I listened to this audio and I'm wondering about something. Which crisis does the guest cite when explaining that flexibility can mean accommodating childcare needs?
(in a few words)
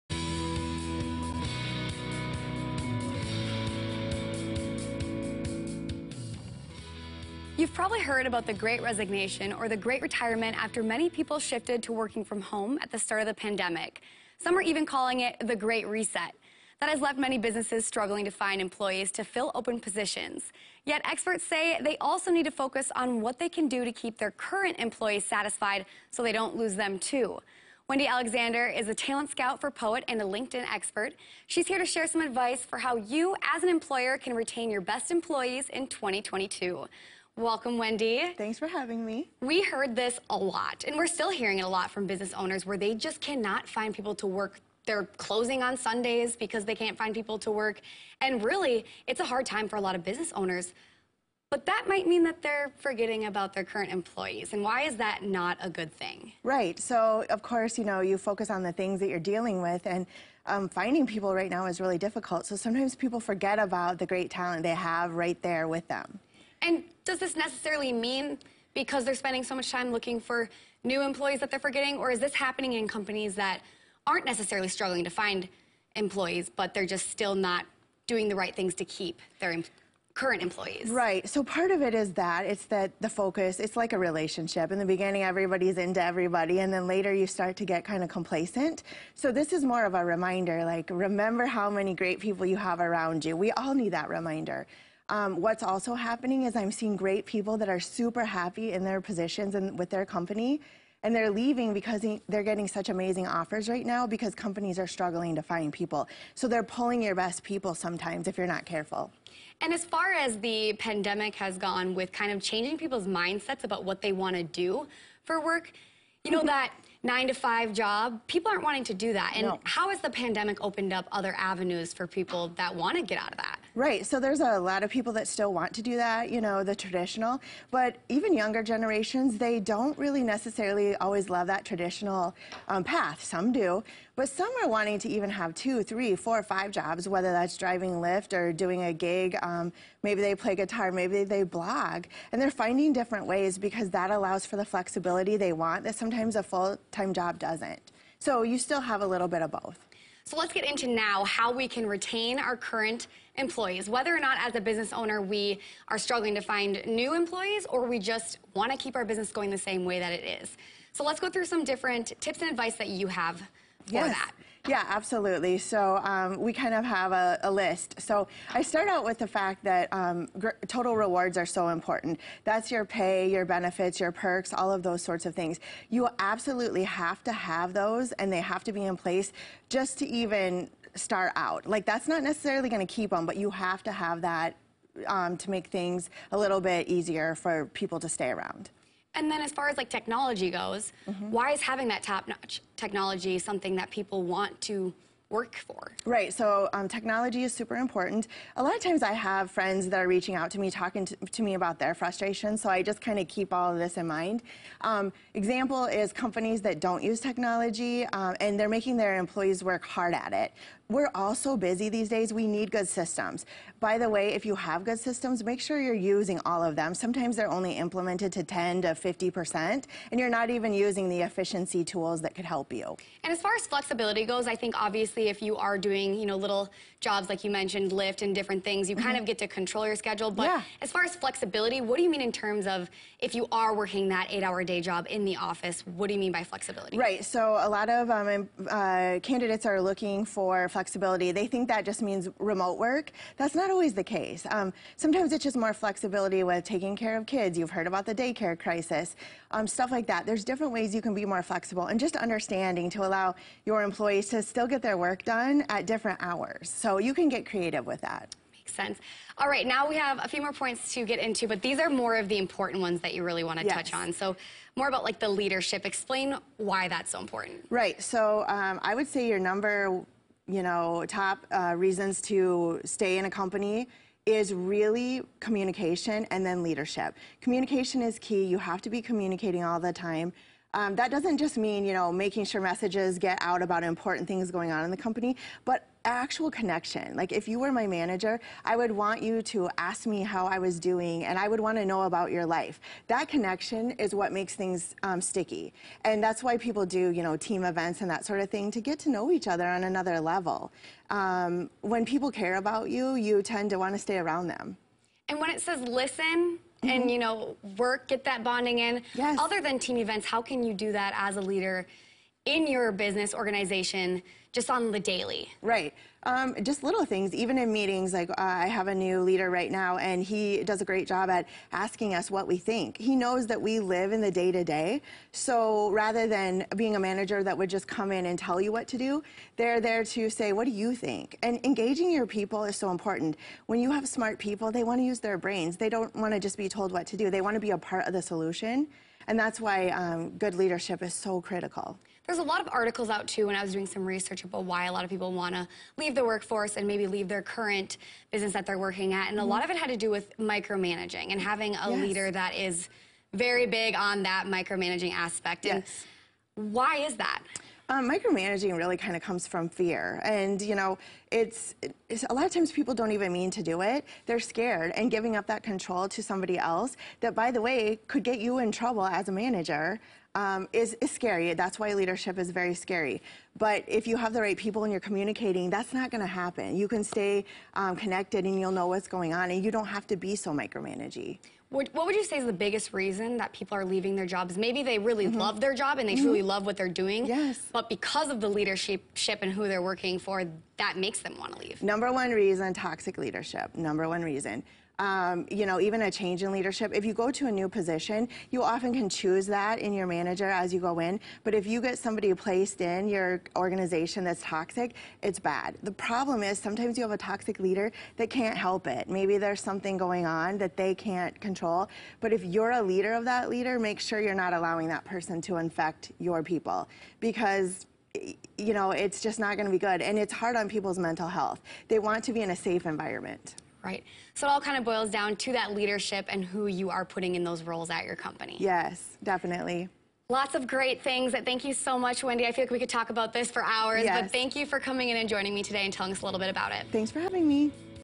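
daycare crisis.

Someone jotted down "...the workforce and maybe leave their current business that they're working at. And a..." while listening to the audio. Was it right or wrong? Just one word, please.
right.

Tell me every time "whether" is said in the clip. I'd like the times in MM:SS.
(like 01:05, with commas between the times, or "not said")
02:17, 02:33.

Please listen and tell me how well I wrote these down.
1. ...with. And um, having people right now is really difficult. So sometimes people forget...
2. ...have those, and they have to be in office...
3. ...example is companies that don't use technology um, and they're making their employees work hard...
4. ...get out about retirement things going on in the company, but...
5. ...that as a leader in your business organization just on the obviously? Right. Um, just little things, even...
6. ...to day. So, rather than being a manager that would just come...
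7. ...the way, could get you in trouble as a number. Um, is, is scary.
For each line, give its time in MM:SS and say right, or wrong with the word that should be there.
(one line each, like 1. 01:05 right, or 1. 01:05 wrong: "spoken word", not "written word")
1. 00:59 wrong: "finding", not "having"
2. 02:57 wrong: "place", not "office"
3. 03:25 right
4. 04:43 wrong: "important", not "retirement"
5. 05:10 wrong: "daily", not "obviously"
6. 05:24 right
7. 06:07 wrong: "manager", not "number".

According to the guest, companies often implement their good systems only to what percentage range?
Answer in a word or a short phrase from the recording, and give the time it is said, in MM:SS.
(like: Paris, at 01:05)
10 to 50%, at 03:38.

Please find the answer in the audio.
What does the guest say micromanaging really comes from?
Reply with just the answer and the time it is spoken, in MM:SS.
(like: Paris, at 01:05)
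fear, at 05:59.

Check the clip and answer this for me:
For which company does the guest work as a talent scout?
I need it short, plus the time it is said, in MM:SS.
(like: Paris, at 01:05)
Poet, at 00:29.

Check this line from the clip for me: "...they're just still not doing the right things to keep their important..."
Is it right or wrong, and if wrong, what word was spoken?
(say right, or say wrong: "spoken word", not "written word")
wrong: "current", not "important".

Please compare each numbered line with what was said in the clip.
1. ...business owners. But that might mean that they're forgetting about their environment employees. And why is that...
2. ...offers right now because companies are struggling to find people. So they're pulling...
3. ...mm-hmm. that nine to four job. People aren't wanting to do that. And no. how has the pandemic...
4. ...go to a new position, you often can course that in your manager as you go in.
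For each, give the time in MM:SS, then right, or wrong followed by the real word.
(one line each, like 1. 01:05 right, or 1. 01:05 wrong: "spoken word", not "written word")
1. 00:50 wrong: "current", not "environment"
2. 01:43 right
3. 01:56 wrong: "five", not "four"
4. 06:37 wrong: "choose", not "course".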